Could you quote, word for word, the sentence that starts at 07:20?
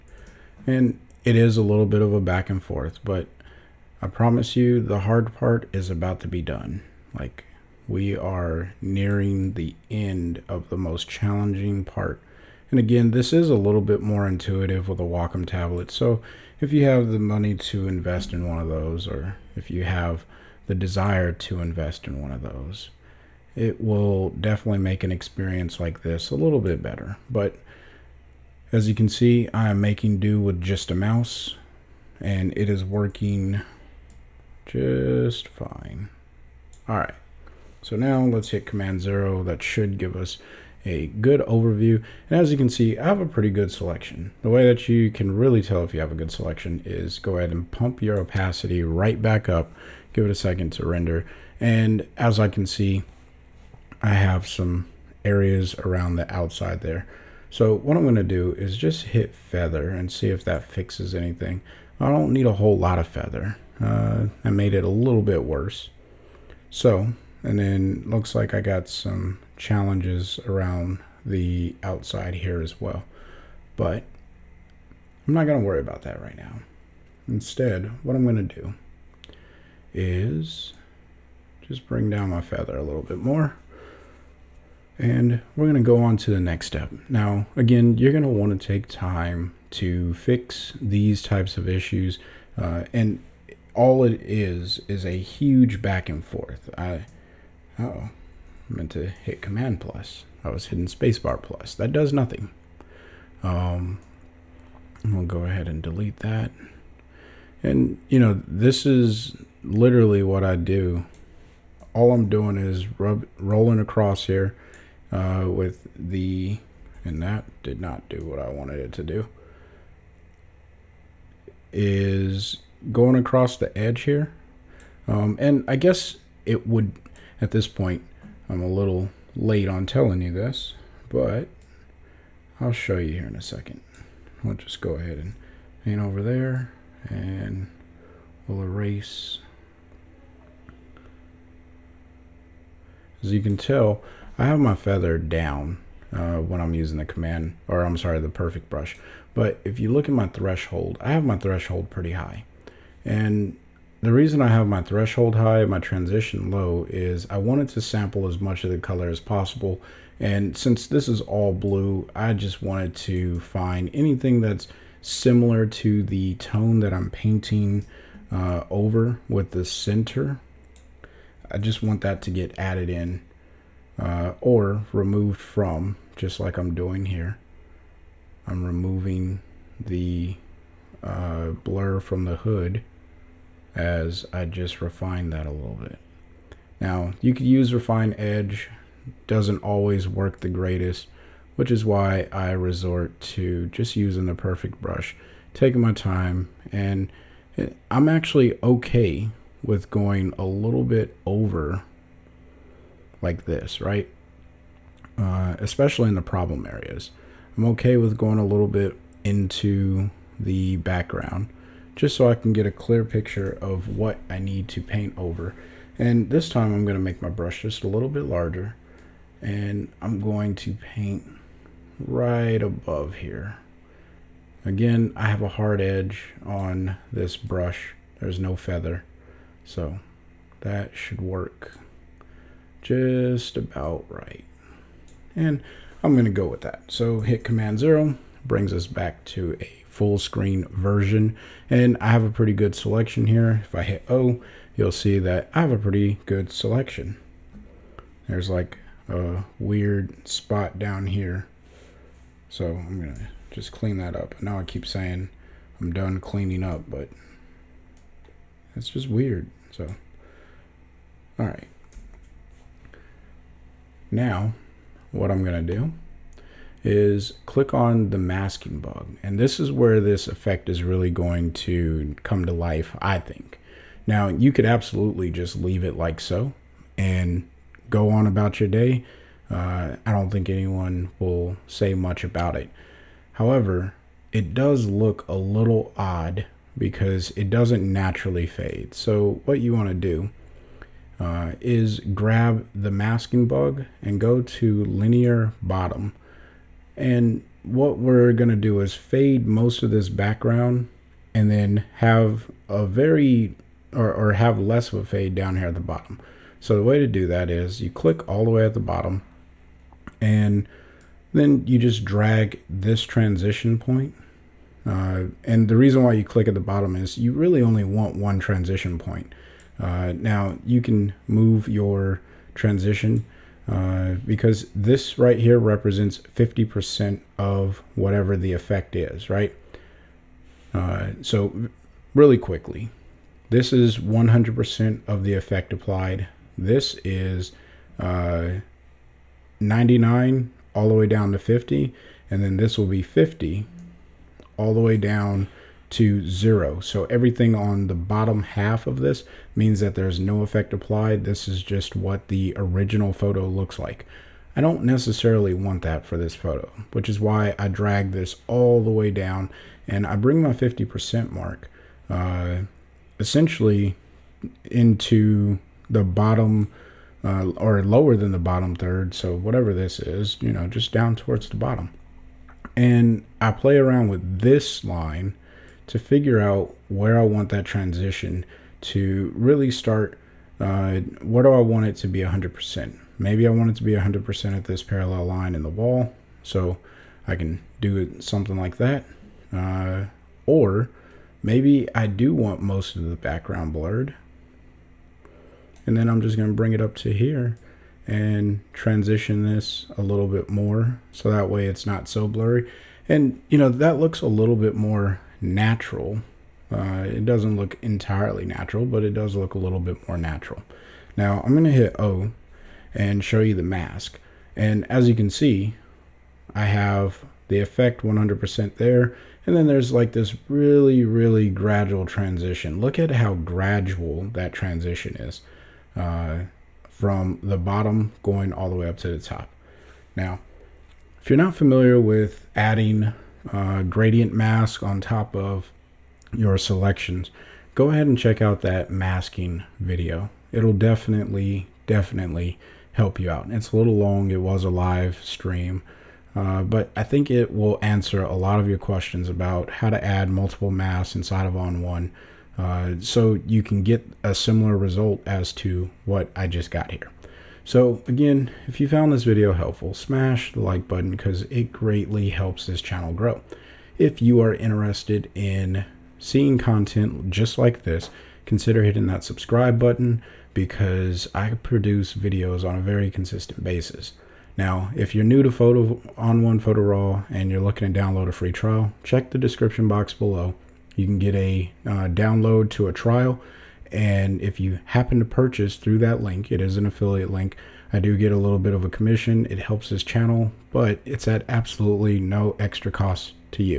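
It'll definitely, definitely help you out.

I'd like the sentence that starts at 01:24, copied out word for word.
And we're going to go on to the next step.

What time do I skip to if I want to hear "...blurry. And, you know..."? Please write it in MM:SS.
06:42.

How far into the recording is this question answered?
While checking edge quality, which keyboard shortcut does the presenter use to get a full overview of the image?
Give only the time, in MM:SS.
00:38.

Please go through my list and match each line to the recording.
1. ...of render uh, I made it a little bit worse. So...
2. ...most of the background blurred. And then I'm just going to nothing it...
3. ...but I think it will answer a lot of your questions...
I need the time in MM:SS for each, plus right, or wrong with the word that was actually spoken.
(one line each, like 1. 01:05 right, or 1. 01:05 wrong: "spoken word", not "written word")
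1. 01:02 wrong: "feather", not "render"
2. 06:32 wrong: "bring", not "nothing"
3. 07:26 right.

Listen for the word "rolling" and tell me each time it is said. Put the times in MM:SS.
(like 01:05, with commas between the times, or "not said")
01:53.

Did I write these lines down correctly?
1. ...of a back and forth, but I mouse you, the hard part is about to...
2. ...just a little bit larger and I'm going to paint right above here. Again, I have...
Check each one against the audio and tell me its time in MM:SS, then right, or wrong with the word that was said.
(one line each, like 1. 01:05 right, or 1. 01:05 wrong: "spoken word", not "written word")
1. 00:02 wrong: "promise", not "mouse"
2. 03:37 right.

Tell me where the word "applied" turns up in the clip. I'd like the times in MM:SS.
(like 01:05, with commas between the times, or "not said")
05:35, 05:50.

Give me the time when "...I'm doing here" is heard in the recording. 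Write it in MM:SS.
02:56.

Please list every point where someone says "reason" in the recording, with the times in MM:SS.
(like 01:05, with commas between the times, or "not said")
02:34, 05:15.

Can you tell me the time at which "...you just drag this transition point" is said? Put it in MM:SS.
05:11.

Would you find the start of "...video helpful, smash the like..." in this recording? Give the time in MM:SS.
07:39.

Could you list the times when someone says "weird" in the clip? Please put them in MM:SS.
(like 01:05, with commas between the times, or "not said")
04:09, 04:19.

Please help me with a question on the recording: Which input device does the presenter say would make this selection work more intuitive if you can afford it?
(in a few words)
Wacom tablet.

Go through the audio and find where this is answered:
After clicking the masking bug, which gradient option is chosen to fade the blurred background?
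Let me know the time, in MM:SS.
04:54.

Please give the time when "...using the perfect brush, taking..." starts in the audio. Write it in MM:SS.
03:13.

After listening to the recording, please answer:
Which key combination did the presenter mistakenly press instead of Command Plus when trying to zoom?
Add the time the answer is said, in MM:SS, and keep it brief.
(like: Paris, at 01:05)
Spacebar Plus, at 01:40.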